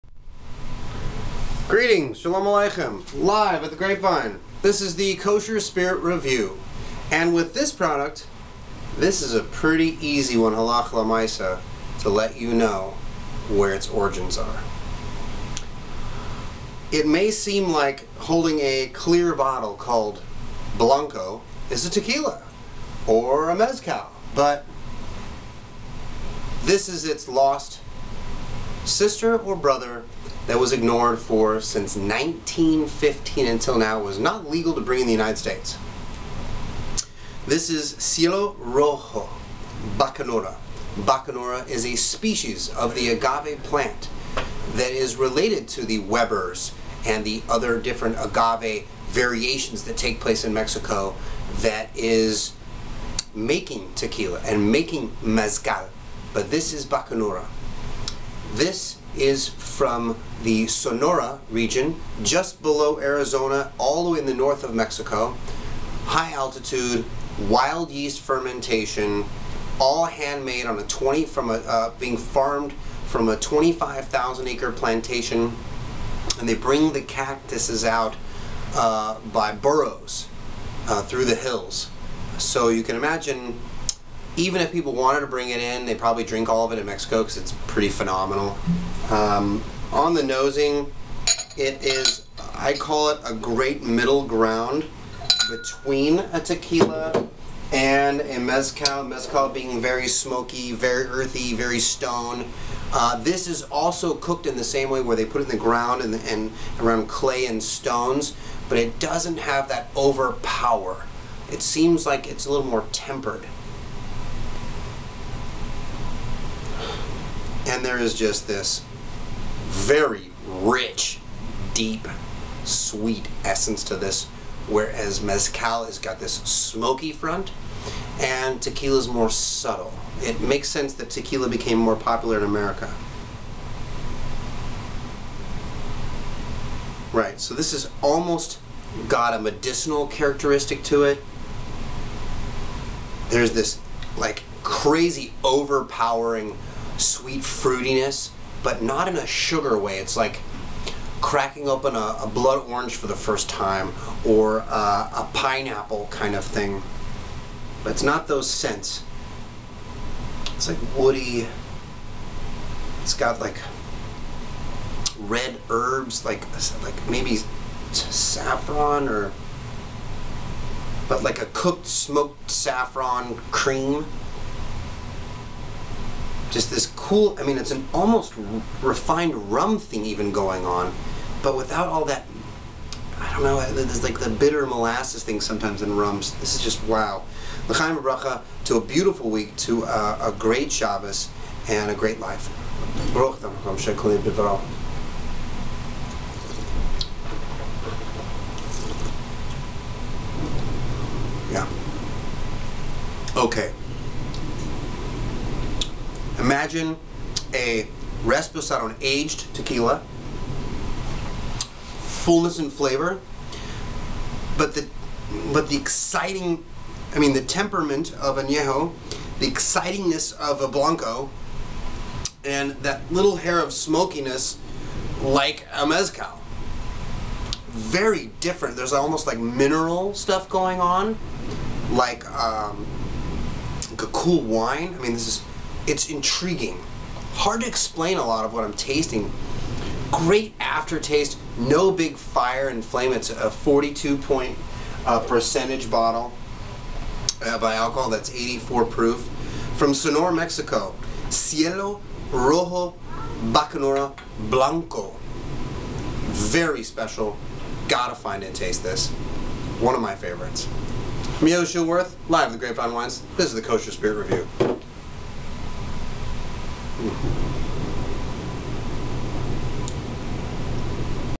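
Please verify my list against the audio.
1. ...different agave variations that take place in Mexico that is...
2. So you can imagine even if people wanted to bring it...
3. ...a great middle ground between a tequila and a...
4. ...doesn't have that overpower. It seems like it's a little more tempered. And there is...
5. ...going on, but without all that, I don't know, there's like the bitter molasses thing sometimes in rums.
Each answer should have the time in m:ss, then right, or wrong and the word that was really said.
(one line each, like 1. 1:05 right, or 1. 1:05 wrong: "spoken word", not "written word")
1. 0:47 right
2. 1:22 right
3. 1:33 right
4. 1:48 right
5. 3:00 right.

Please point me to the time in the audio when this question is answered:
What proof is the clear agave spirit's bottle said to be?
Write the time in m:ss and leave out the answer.
4:08.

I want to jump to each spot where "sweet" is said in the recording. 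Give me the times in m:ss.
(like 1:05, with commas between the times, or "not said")
2:02, 2:26.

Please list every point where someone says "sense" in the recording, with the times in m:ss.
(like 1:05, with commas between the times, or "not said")
2:10.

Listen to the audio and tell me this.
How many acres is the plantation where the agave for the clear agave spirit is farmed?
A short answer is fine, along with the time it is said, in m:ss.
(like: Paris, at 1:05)
25,000 acres, at 1:13.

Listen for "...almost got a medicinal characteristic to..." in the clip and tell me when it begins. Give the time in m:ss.
2:18.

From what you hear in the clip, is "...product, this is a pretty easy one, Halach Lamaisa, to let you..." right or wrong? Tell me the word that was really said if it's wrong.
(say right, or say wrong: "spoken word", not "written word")
right.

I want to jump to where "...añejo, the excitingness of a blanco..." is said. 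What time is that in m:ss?
3:38.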